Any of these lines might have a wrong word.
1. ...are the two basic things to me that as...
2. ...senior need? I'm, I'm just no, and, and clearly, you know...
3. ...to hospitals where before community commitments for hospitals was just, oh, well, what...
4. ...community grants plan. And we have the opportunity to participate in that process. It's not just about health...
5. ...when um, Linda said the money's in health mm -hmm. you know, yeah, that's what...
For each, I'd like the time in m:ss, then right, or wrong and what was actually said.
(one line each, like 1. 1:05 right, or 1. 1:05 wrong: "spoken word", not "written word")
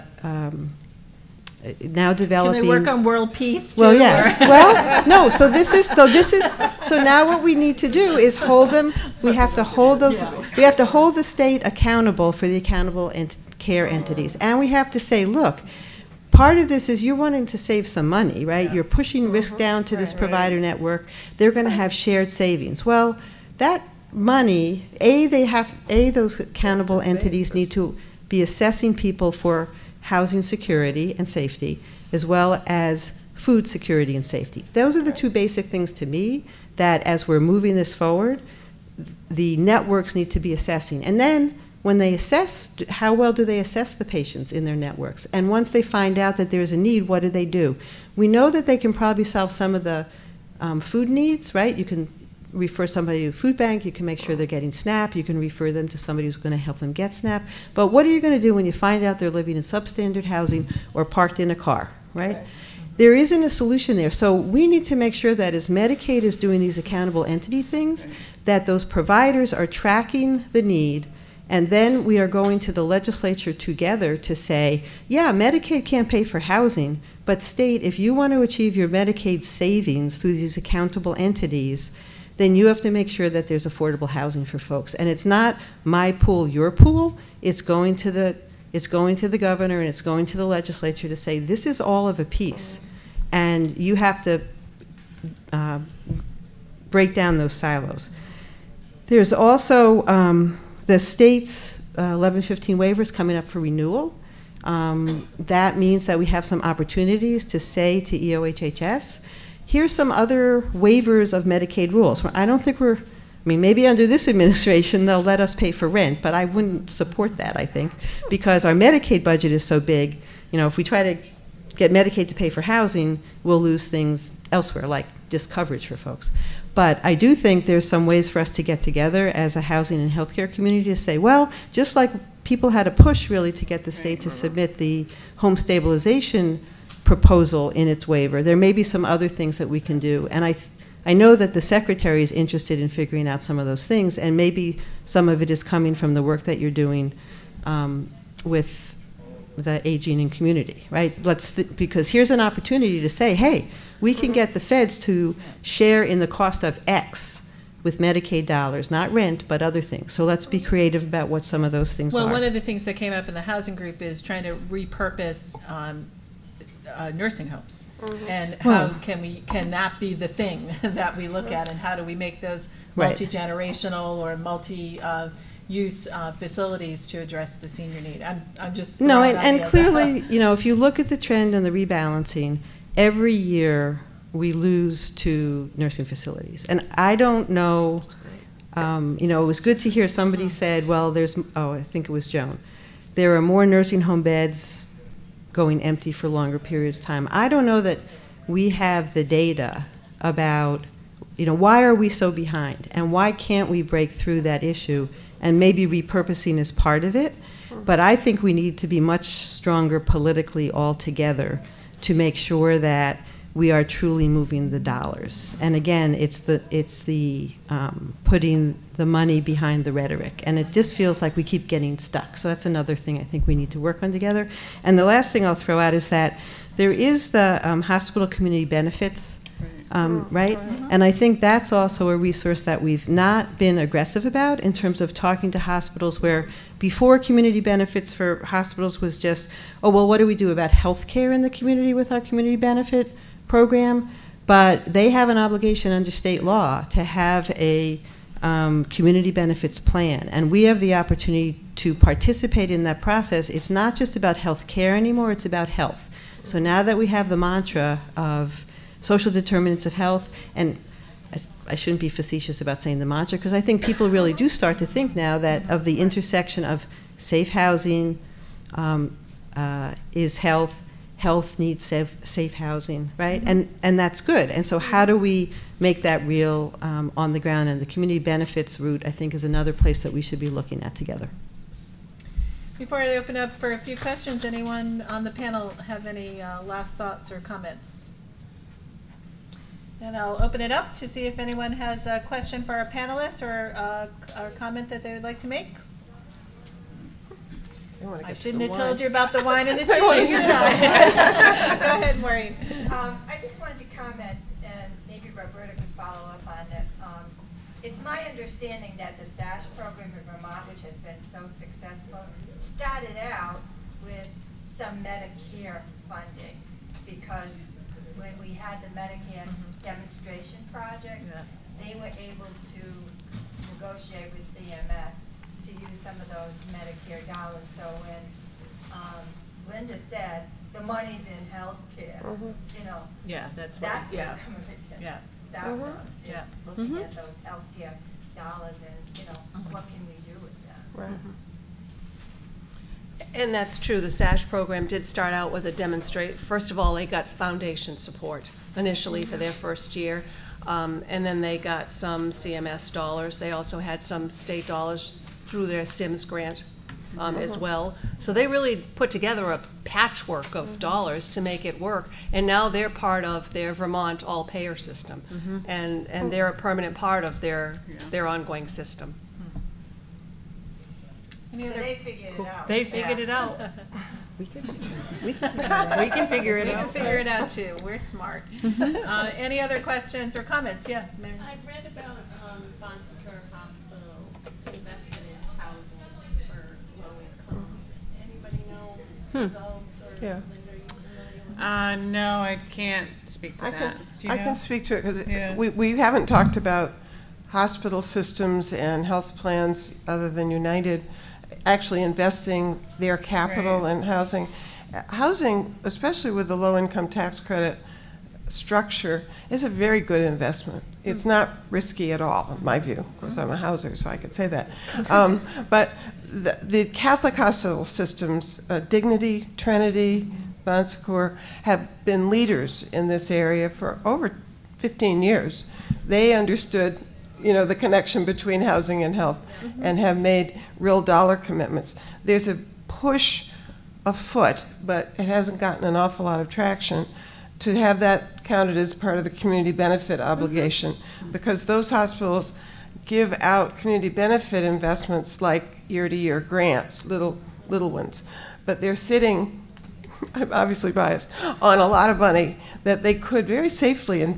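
1. 0:34 right
2. 2:57 right
3. 3:55 wrong: "benefits", not "commitments"
4. 4:08 wrong: "benefits", not "grants"
5. 5:28 right.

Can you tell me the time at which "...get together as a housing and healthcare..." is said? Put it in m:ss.
2:08.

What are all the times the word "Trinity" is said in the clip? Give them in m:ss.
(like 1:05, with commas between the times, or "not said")
6:59.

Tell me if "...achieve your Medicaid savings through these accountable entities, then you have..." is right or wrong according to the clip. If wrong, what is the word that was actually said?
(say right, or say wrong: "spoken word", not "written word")
right.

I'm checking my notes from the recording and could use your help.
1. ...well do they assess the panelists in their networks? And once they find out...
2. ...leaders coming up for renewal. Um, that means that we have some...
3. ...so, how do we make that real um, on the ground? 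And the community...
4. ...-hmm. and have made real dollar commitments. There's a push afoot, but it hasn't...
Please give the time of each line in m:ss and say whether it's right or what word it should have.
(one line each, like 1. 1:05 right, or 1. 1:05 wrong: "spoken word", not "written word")
1. 0:43 wrong: "patients", not "panelists"
2. 1:42 wrong: "waivers", not "leaders"
3. 4:34 right
4. 7:09 right.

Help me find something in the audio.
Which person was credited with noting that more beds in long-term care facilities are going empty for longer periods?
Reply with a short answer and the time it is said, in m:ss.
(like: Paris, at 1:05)
Joan, at 3:12.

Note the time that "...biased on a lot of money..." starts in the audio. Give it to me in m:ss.
7:30.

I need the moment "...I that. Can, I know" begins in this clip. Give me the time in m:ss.
6:33.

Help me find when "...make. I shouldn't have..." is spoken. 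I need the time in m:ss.
4:55.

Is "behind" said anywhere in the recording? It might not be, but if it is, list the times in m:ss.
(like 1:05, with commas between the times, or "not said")
3:22, 3:39.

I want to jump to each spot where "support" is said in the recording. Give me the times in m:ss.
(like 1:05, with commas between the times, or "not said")
1:56, 5:47.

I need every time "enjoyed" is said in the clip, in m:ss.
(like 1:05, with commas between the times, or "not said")
not said.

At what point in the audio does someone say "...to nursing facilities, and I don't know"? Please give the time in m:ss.
3:05.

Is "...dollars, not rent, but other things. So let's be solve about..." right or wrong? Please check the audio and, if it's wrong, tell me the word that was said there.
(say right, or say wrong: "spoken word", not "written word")
wrong: "creative", not "solve".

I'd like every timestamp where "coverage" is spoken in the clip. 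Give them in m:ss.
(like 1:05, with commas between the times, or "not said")
2:05.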